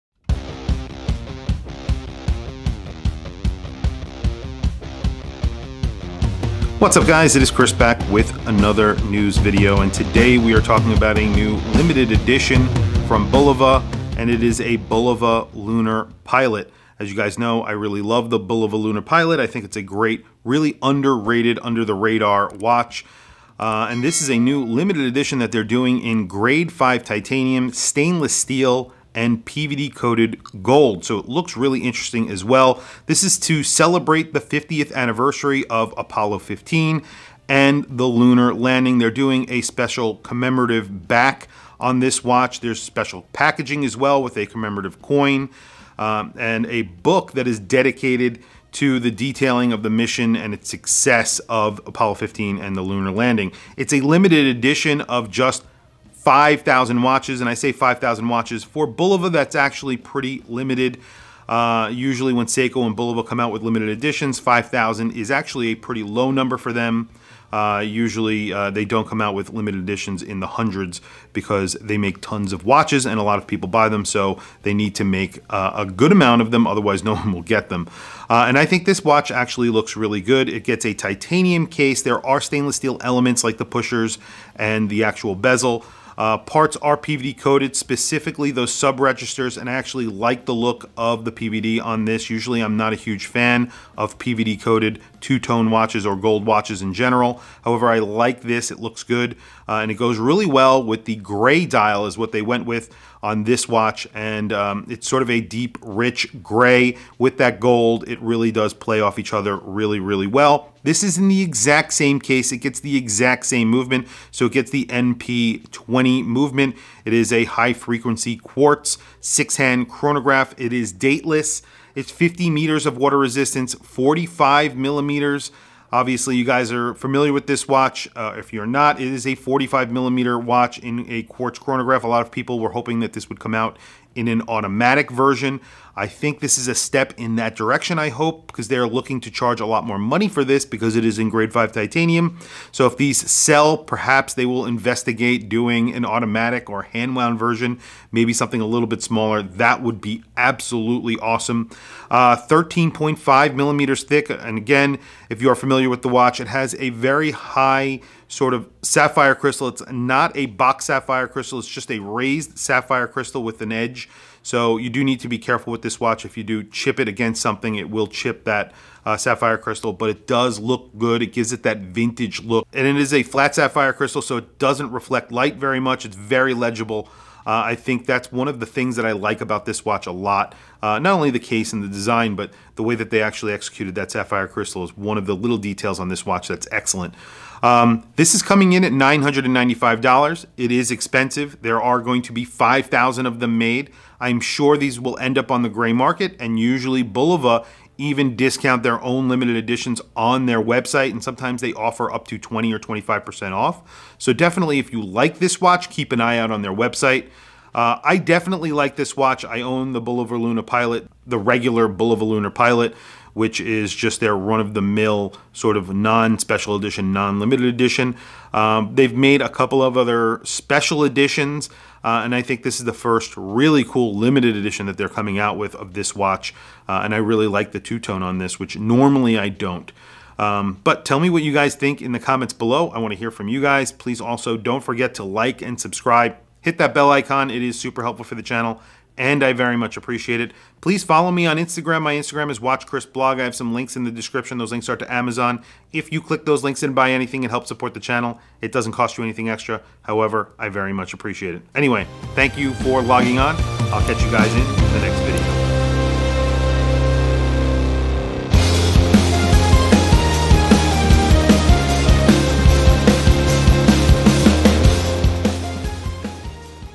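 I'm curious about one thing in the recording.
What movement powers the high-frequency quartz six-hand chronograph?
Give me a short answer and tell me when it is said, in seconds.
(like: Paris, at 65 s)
NP20, at 114 s.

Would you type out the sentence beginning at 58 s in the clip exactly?
For Bulova, that's actually pretty limited.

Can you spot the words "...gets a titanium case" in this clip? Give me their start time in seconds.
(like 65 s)
80 s.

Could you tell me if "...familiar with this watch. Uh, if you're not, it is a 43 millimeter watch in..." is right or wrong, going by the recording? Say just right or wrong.
wrong.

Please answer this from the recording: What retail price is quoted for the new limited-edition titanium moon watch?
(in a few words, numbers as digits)
$995.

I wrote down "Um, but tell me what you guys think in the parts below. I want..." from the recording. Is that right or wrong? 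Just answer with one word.
wrong.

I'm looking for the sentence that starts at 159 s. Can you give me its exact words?
It's not a box sapphire crystal, it's just a raised sapphire crystal with an edge.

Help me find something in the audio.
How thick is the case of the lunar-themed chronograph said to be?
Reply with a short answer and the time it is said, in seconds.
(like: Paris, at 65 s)
13.5 millimeters, at 152 s.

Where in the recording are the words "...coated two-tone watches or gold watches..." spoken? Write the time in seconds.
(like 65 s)
94 s.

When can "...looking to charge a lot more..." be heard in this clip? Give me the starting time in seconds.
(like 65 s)
138 s.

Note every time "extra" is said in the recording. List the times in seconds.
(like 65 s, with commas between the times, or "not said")
249 s.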